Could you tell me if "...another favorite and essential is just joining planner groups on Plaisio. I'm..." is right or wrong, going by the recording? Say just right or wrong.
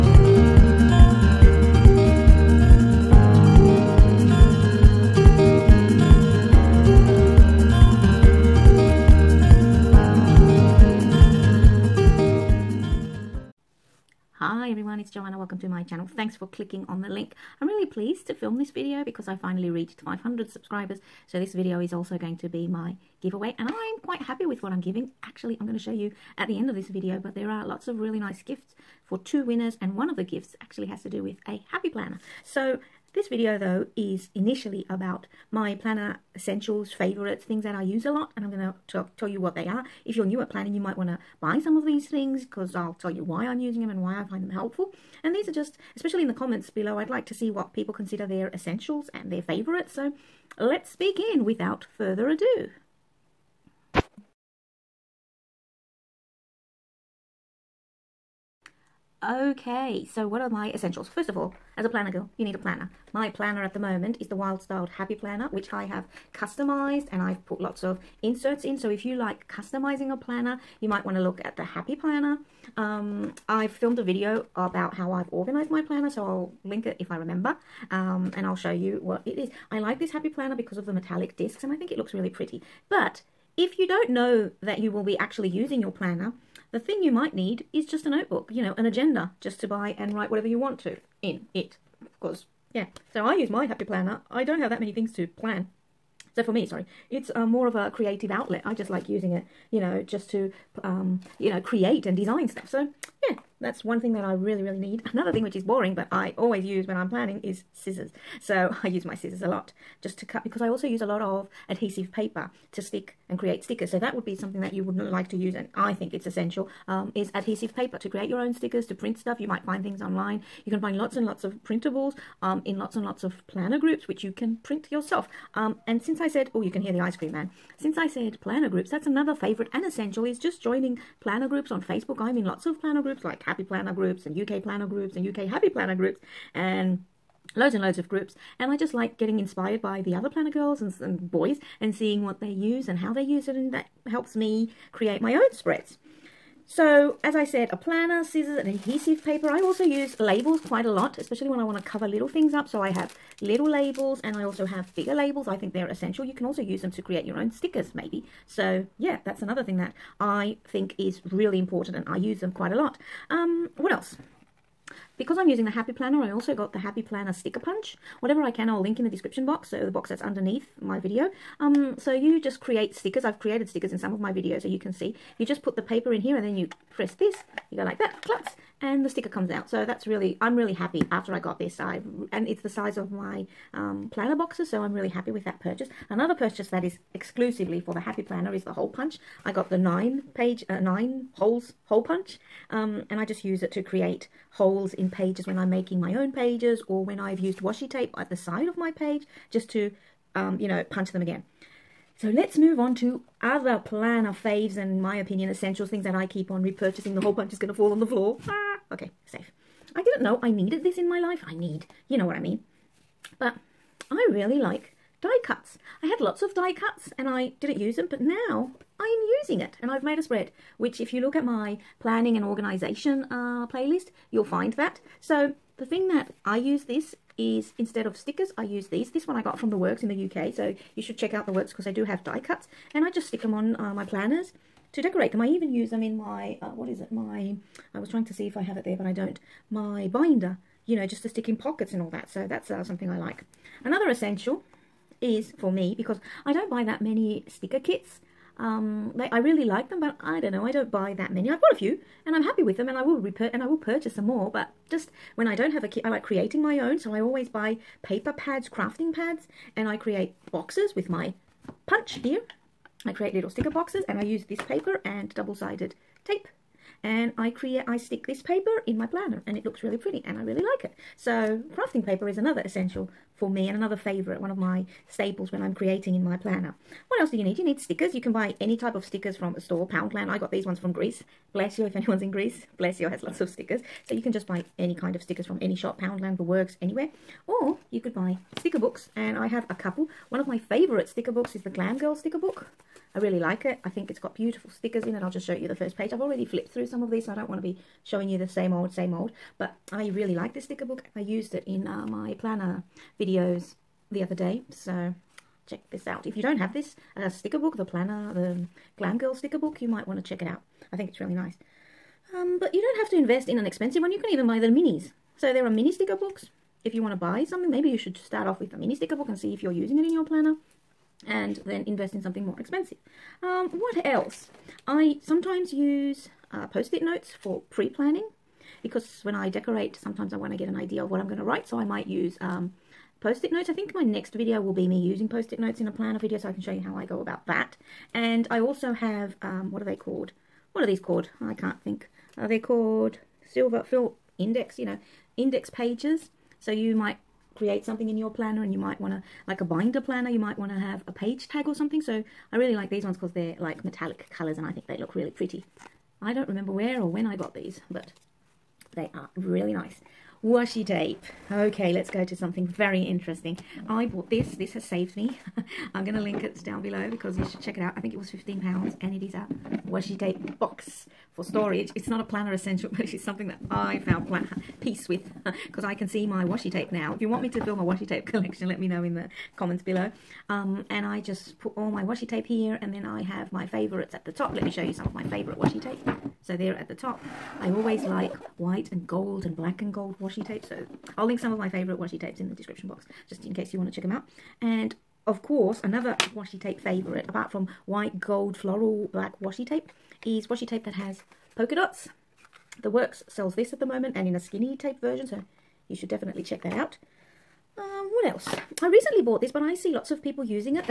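wrong.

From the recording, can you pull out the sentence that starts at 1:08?
So if you like customizing a planner, you might want to look at the Happy Planner.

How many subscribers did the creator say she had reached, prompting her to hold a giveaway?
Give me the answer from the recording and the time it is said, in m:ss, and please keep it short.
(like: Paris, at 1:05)
500, at 0:19.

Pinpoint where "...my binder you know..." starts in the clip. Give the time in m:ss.
3:59.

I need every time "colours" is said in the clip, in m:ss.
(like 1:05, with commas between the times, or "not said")
5:54.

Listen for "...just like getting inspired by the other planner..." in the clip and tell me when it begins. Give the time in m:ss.
2:18.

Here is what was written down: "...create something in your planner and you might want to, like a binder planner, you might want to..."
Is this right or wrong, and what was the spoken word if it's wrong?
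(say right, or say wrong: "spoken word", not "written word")
right.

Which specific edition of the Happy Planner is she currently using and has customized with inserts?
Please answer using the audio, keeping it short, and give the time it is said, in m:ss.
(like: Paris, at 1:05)
Wild Styled, at 1:04.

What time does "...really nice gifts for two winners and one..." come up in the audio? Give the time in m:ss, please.
0:27.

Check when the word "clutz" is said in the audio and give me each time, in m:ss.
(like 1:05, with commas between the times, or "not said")
2:58.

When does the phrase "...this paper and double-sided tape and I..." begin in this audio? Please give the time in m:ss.
4:24.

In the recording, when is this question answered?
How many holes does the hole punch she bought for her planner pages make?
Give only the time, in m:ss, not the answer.
3:10.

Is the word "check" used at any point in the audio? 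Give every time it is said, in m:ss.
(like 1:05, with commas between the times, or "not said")
3:51, 5:05, 5:10, 6:07, 6:33, 6:46.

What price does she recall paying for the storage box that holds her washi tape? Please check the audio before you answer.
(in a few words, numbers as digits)
£15.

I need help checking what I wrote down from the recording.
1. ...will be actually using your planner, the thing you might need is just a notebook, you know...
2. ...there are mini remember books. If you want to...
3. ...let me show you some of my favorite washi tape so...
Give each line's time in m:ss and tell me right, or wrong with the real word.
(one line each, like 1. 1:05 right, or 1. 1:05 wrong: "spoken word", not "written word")
1. 1:24 right
2. 5:15 wrong: "sticker", not "remember"
3. 6:24 right.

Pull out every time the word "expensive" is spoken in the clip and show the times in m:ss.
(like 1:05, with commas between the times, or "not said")
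5:13, 5:22.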